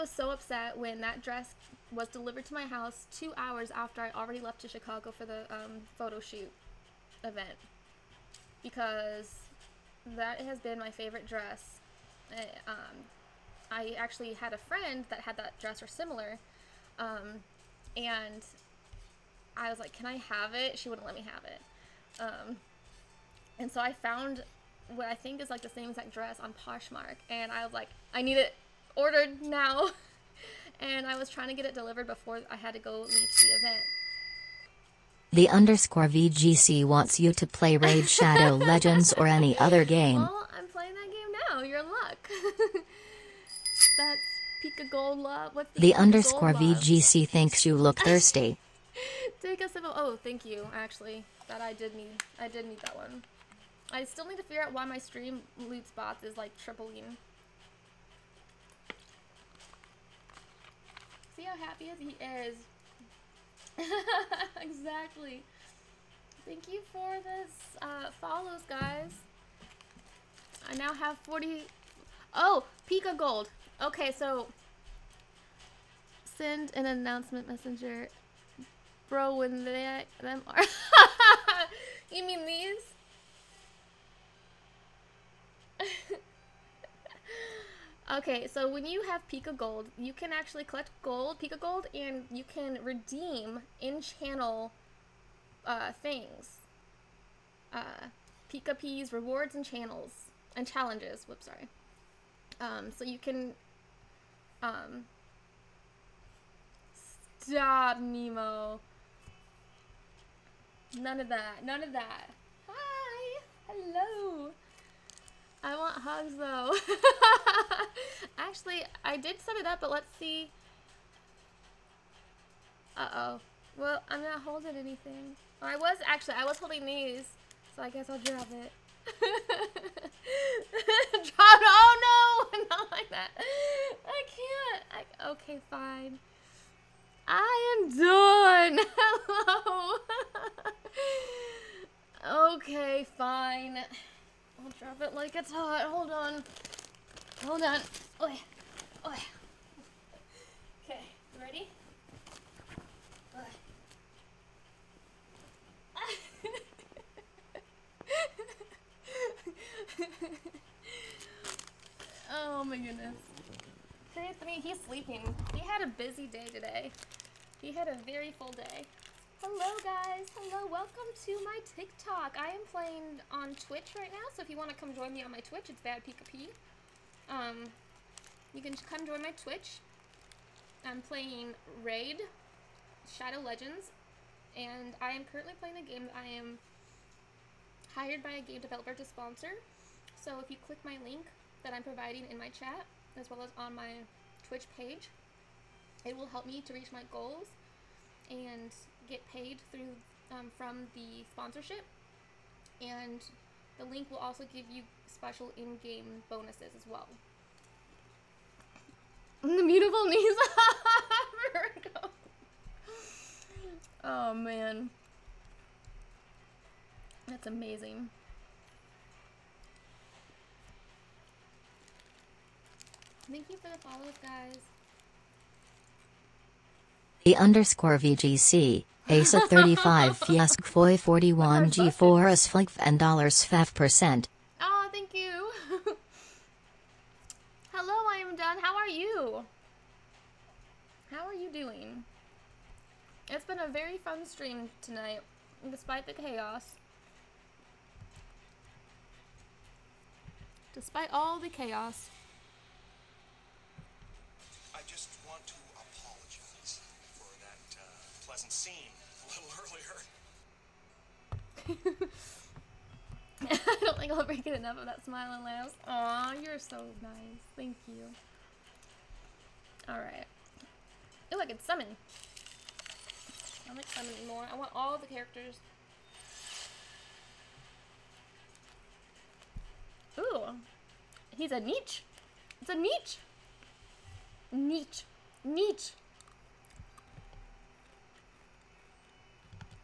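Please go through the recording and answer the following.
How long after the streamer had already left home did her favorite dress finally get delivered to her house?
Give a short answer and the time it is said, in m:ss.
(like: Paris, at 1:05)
2 hours, at 0:03.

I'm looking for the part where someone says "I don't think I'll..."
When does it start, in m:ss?
4:23.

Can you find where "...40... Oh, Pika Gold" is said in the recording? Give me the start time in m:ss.
1:11.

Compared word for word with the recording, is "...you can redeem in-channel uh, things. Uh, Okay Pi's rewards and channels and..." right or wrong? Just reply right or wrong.
wrong.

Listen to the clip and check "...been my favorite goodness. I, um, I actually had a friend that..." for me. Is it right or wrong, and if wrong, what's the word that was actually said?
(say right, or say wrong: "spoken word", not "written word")
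wrong: "dress", not "goodness".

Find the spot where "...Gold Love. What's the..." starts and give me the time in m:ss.
0:44.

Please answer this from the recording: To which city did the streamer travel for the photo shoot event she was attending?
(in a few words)
Chicago.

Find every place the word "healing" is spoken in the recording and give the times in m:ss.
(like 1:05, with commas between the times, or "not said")
not said.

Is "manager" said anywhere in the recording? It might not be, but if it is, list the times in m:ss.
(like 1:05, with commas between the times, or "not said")
not said.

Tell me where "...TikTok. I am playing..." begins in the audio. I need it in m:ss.
2:51.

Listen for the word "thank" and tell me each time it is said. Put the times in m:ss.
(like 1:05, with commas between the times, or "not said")
0:50, 1:06, 3:43, 3:54, 4:27.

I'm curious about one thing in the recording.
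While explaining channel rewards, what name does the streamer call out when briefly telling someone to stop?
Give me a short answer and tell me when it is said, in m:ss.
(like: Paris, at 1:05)
Nemo, at 1:47.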